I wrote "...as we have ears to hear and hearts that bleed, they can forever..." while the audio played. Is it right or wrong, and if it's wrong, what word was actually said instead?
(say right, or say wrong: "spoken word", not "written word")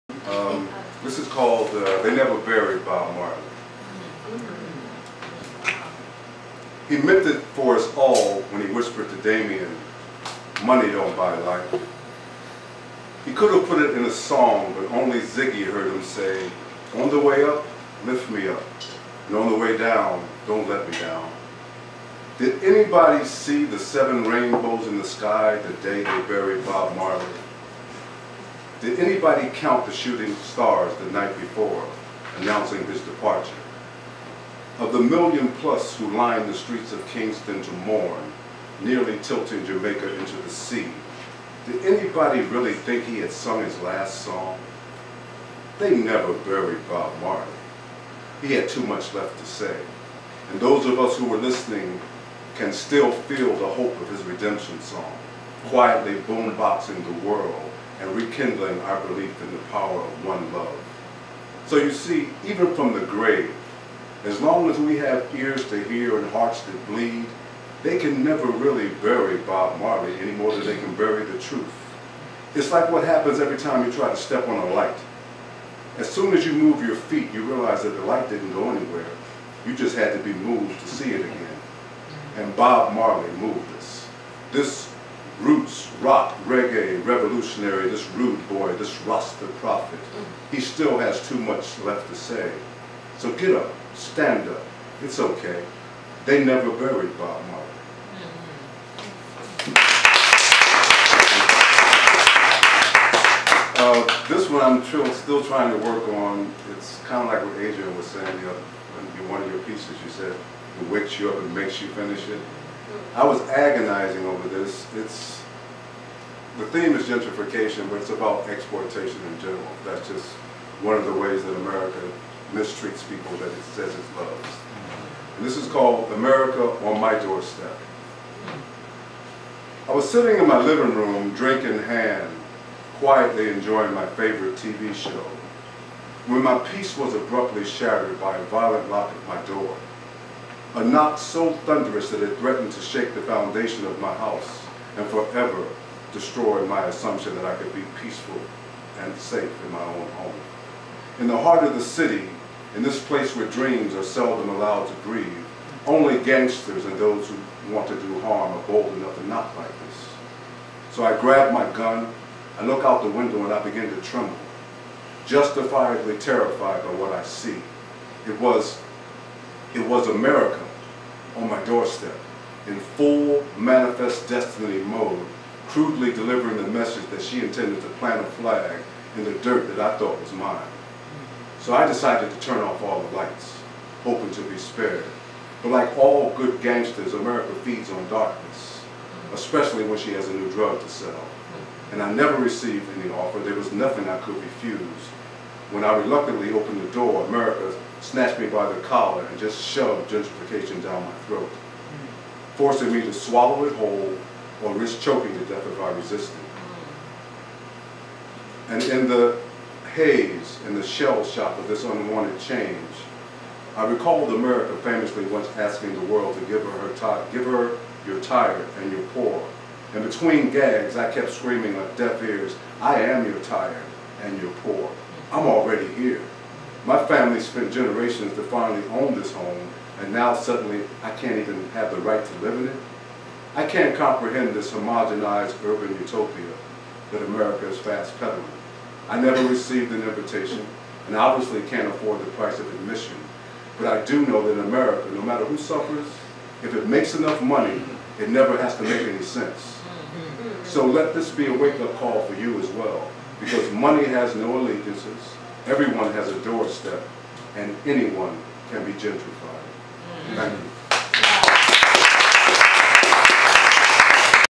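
wrong: "never", not "forever".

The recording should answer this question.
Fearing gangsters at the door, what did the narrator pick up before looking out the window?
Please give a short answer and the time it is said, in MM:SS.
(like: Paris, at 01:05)
gun, at 02:41.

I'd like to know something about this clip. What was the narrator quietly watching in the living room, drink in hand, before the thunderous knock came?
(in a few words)
favorite TV show.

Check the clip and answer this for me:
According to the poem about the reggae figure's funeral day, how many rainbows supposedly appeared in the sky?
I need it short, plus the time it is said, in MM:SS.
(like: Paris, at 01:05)
7, at 00:23.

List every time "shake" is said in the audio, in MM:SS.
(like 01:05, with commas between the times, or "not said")
02:22.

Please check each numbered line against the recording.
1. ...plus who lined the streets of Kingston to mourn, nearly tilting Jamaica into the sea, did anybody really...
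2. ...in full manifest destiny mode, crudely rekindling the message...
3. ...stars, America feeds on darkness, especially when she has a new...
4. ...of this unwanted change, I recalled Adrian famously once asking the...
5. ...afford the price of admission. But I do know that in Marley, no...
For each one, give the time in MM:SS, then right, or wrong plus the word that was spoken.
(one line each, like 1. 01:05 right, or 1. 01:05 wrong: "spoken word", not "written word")
1. 00:35 right
2. 02:52 wrong: "delivering", not "rekindling"
3. 03:06 wrong: "gangsters", not "stars"
4. 03:31 wrong: "America", not "Adrian"
5. 04:01 wrong: "America", not "Marley".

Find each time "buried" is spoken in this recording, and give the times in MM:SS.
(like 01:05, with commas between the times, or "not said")
00:02, 00:26, 00:46, 01:36.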